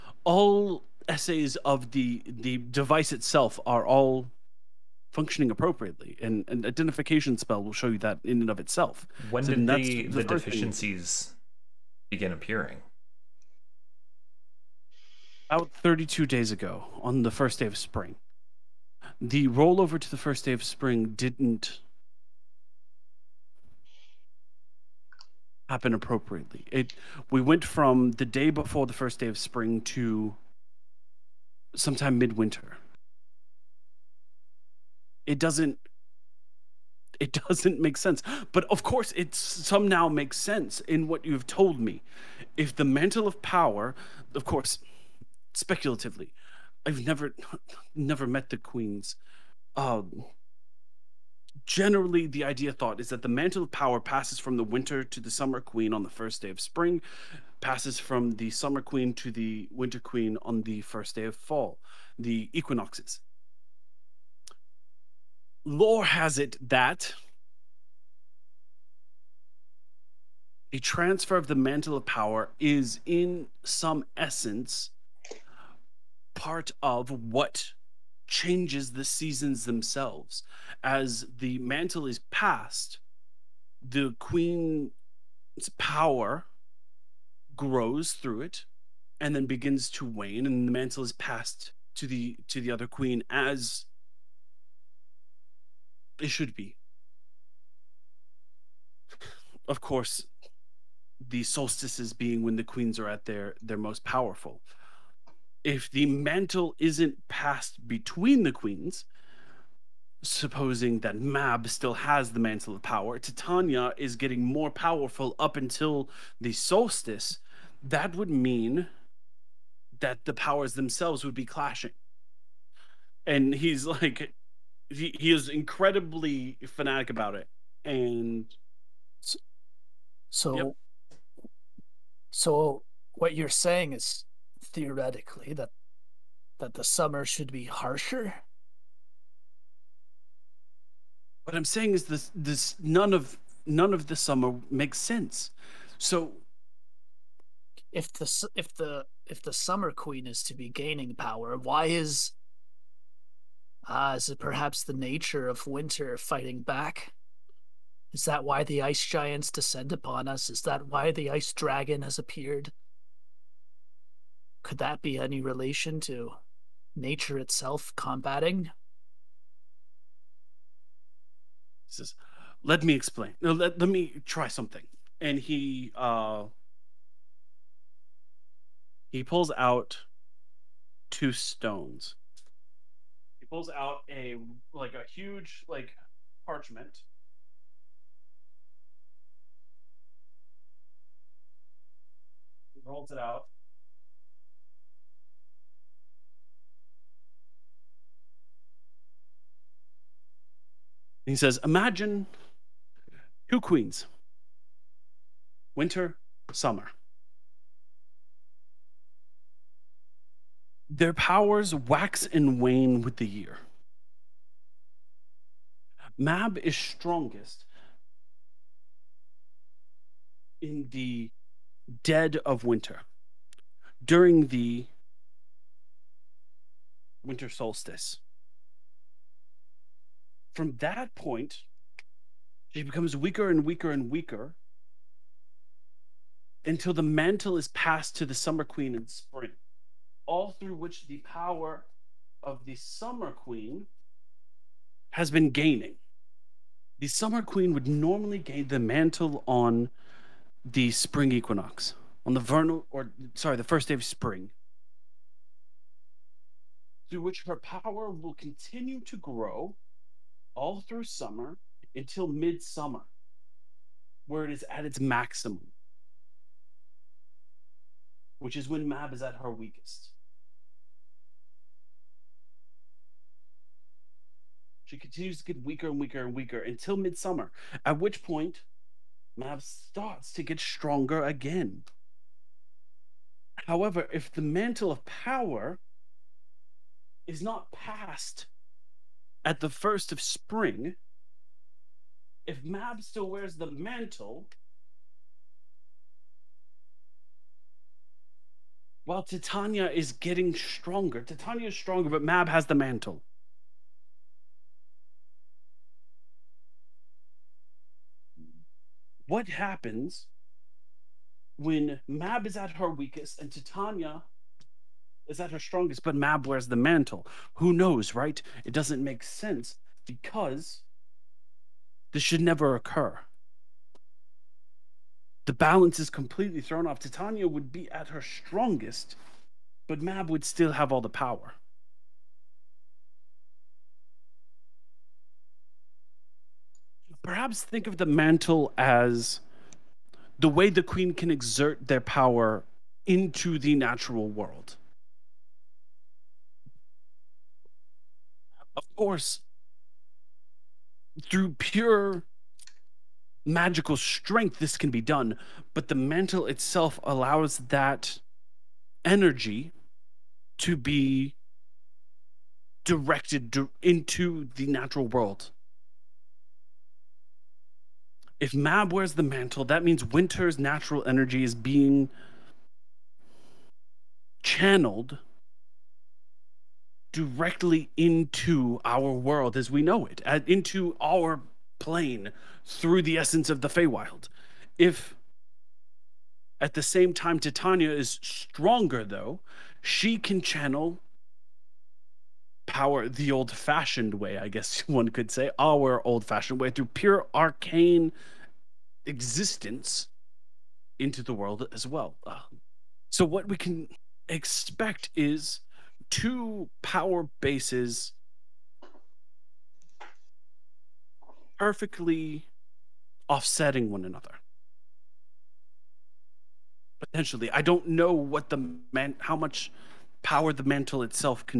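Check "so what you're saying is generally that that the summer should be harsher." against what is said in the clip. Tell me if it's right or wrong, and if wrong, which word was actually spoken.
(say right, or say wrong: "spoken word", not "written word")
wrong: "theoretically", not "generally".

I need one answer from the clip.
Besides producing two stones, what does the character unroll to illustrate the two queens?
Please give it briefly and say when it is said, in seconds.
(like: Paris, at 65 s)
parchment, at 186 s.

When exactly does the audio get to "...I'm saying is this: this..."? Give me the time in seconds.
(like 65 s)
141 s.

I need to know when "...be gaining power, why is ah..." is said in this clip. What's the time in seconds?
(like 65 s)
150 s.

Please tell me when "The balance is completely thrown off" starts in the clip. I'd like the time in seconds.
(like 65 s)
325 s.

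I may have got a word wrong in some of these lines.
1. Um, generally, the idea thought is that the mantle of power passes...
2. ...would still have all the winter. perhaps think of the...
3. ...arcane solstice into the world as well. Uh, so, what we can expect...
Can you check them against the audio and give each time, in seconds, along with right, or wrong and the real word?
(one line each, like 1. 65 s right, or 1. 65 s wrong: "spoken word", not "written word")
1. 49 s right
2. 330 s wrong: "power", not "winter"
3. 397 s wrong: "existence", not "solstice".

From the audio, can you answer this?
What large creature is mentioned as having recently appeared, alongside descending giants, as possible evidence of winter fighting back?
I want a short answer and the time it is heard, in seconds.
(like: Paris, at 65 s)
ice dragon, at 161 s.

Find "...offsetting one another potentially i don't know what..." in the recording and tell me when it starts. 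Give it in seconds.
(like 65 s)
413 s.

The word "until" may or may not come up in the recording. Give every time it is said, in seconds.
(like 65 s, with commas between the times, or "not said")
115 s, 236 s, 261 s, 276 s.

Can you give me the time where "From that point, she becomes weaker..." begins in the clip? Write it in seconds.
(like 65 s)
230 s.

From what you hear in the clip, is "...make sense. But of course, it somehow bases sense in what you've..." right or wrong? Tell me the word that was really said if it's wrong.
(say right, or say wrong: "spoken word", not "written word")
wrong: "makes", not "bases".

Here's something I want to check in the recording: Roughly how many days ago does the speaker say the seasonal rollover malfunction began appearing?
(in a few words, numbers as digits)
32 days.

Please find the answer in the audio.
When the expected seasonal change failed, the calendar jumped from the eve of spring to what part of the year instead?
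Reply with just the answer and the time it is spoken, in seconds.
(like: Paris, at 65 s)
midwinter, at 32 s.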